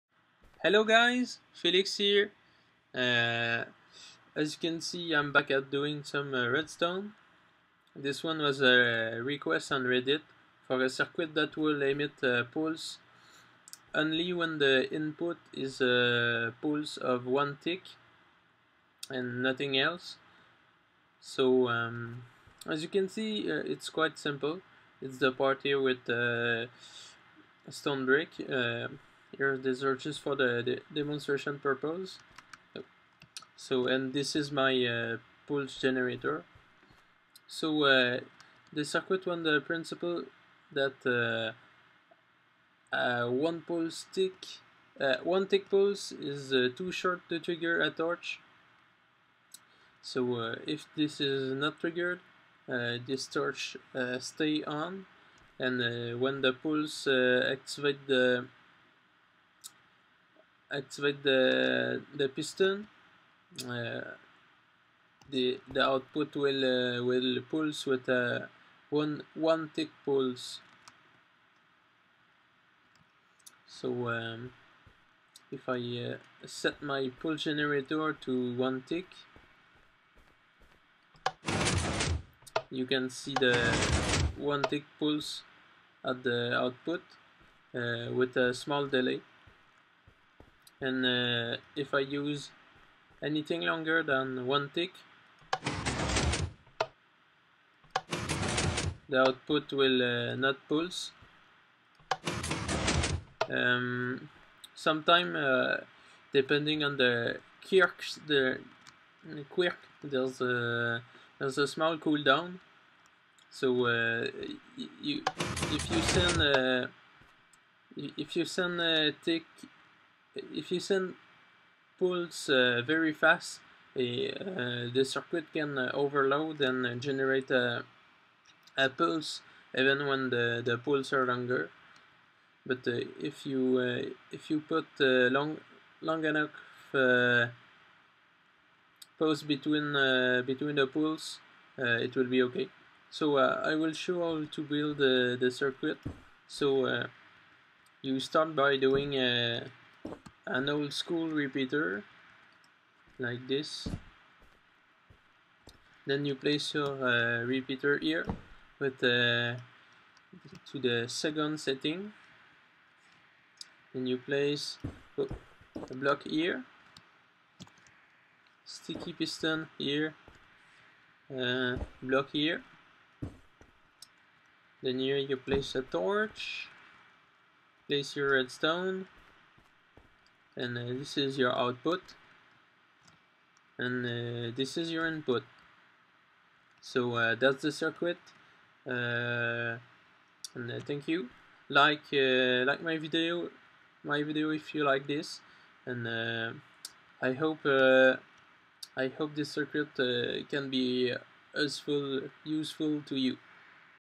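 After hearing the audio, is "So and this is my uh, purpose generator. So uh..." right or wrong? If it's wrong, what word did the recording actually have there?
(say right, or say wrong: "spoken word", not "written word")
wrong: "pulse", not "purpose".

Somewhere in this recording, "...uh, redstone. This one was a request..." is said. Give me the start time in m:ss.
0:06.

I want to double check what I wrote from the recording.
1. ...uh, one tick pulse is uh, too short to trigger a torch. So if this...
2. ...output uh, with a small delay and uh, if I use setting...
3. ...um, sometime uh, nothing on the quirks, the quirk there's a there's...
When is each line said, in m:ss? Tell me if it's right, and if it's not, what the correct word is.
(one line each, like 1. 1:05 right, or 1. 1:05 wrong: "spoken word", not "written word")
1. 0:44 right
2. 1:26 wrong: "anything", not "setting"
3. 1:43 wrong: "depending", not "nothing".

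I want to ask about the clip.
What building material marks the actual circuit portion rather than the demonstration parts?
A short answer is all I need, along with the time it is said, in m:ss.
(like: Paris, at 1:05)
stone brick, at 0:27.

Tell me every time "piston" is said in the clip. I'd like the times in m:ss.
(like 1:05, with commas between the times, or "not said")
1:02, 2:49.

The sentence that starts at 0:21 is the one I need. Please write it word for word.
So um, as you can see, uh, it's quite simple.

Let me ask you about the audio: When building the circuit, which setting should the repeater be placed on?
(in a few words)
second setting.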